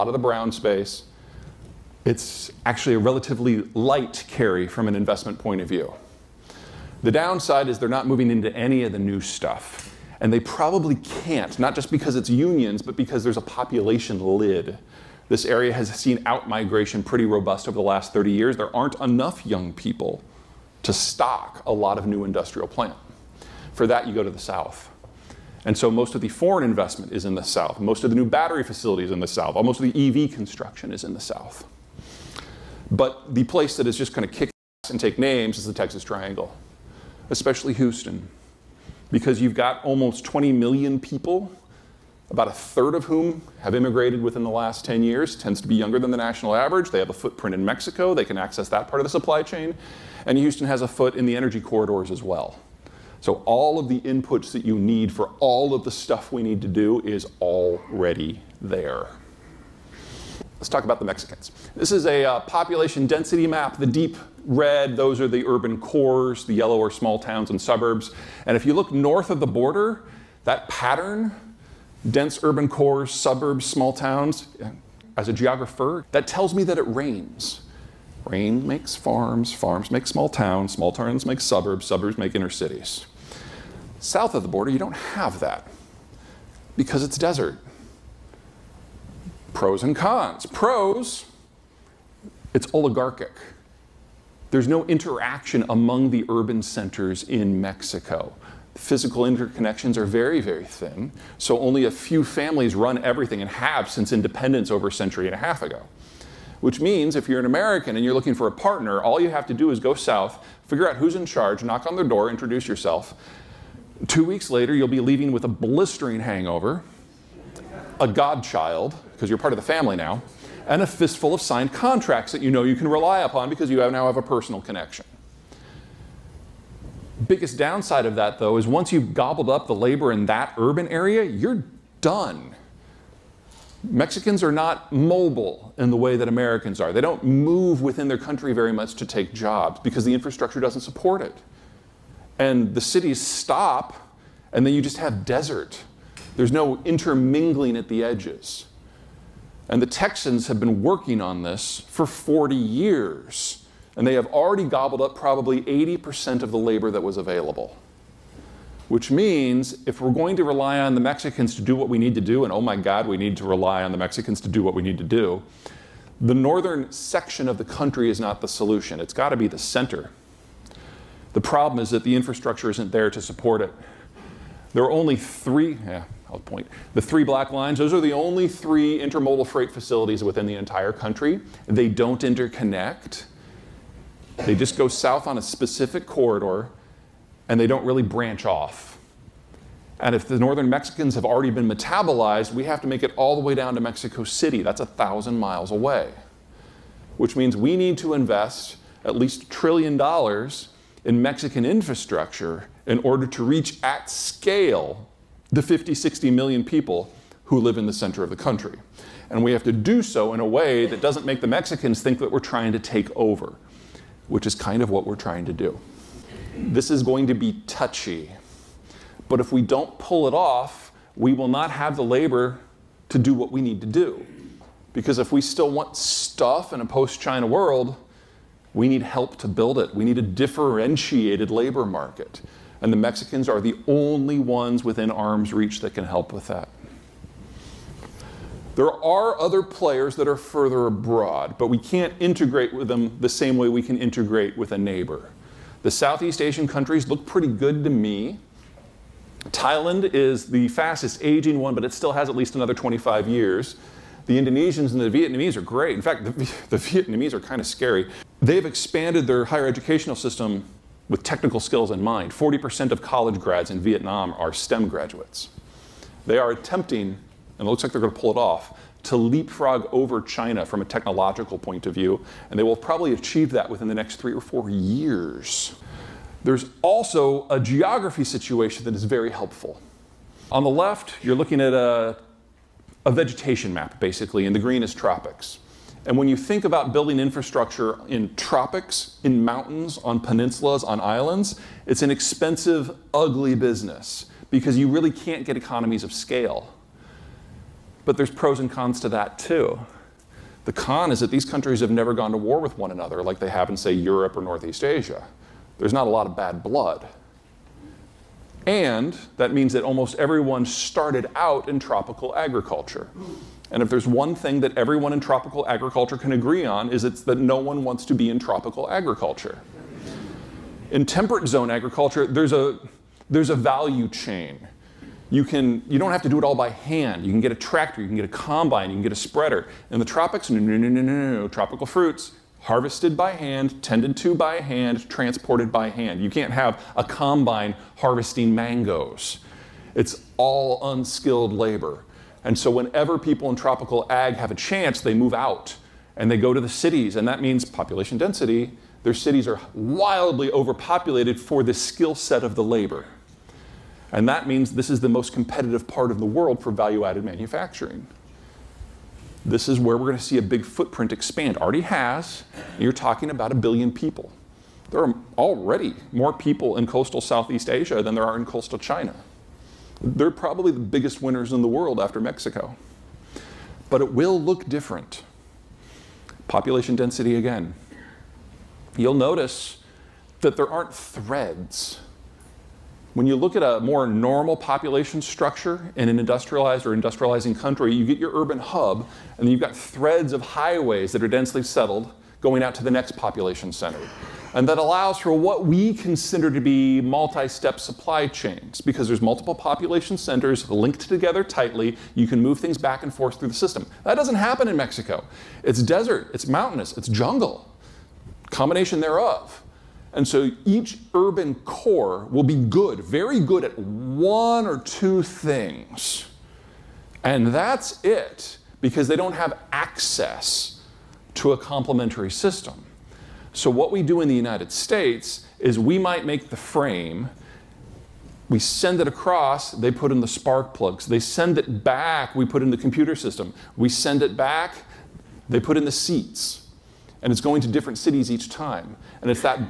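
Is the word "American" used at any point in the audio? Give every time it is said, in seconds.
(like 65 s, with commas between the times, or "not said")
107 s, 136 s.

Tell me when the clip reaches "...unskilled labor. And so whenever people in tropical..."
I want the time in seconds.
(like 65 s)
340 s.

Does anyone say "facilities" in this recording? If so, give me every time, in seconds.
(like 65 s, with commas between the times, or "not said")
28 s, 179 s.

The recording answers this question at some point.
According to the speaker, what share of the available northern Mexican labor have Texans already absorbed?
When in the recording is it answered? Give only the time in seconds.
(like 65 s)
155 s.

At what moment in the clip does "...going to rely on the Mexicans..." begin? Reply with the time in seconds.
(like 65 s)
160 s.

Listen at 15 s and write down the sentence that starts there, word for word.
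This area has seen outmigration pretty robust over the last 30 years.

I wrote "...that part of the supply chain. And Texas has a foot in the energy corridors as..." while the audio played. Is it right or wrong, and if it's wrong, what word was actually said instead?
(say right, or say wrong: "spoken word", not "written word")
wrong: "Houston", not "Texas".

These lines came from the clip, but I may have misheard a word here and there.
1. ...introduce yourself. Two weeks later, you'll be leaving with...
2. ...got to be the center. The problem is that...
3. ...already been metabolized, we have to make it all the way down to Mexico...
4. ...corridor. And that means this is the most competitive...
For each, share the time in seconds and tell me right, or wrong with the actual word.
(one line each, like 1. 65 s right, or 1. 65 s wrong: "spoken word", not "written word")
1. 112 s right
2. 169 s right
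3. 191 s right
4. 352 s wrong: "labor", not "corridor".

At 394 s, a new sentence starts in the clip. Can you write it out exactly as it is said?
And that allows for what we consider to be multi step supply chains because there's multiple population centers linked together tightly.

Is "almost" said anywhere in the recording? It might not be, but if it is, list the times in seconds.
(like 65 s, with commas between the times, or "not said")
29 s, 39 s, 309 s.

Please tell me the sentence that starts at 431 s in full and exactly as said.
They send it back, we put in the computer system.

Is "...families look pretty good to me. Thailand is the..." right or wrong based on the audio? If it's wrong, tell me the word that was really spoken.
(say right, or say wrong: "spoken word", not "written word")
wrong: "countries", not "families".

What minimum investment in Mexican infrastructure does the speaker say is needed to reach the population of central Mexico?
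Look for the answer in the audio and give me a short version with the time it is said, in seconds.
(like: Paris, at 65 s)
1 trillion dollars, at 199 s.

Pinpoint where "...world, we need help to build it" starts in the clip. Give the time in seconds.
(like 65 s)
227 s.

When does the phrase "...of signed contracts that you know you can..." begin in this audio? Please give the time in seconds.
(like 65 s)
121 s.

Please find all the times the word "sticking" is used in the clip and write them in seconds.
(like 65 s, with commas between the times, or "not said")
not said.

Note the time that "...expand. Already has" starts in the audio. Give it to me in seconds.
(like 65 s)
361 s.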